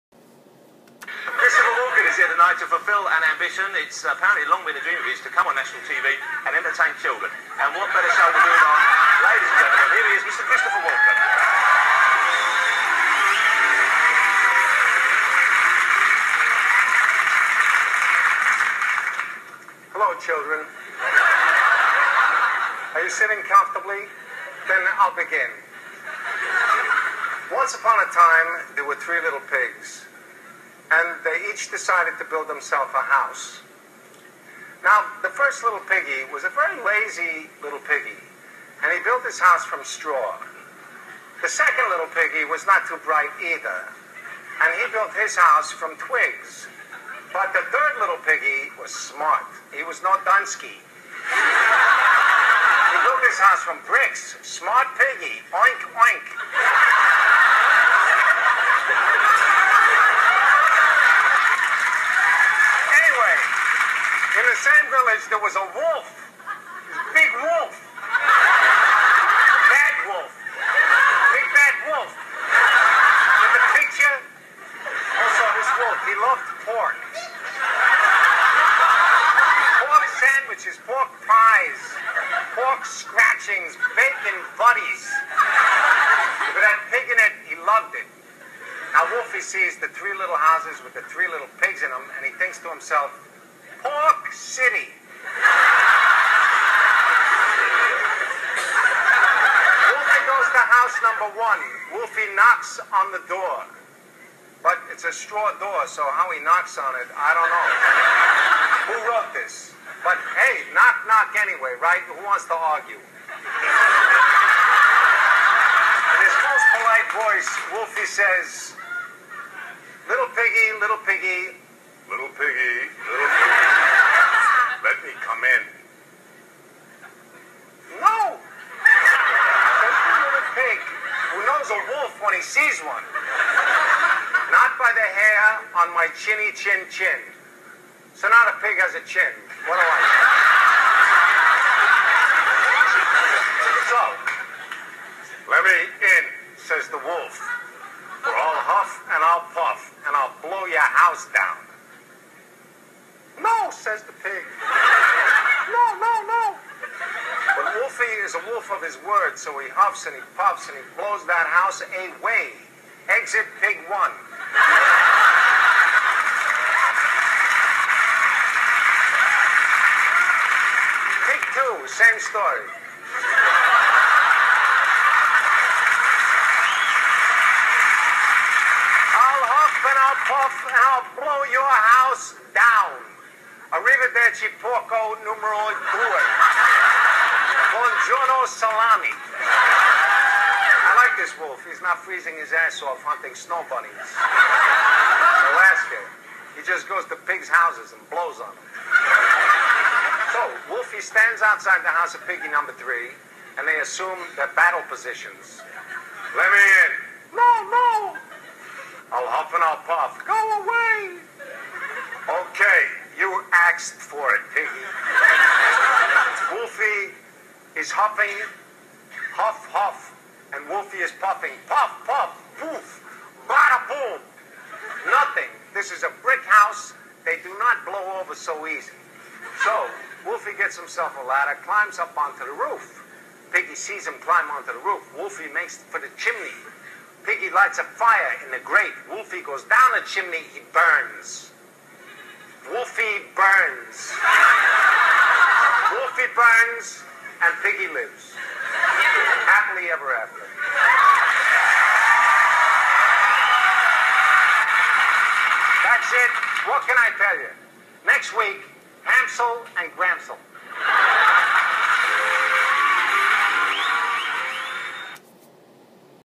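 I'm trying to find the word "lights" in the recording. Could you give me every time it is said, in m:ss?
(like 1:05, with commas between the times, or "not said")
3:57.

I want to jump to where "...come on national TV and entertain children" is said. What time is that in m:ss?
0:05.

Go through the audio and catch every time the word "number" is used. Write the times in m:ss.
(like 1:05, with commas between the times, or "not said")
1:41, 3:22.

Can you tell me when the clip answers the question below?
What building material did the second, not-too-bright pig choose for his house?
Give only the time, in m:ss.
0:45.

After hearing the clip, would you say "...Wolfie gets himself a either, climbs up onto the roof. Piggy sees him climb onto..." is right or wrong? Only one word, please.
wrong.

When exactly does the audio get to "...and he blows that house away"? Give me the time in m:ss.
2:40.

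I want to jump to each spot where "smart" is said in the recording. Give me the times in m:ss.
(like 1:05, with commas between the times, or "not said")
0:48, 0:54.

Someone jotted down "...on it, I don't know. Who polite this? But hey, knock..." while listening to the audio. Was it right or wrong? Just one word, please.
wrong.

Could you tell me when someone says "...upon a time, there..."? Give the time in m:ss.
0:27.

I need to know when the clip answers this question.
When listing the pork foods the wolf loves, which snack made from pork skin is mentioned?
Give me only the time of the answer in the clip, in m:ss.
1:22.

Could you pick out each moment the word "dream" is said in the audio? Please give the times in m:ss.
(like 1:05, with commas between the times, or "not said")
0:04.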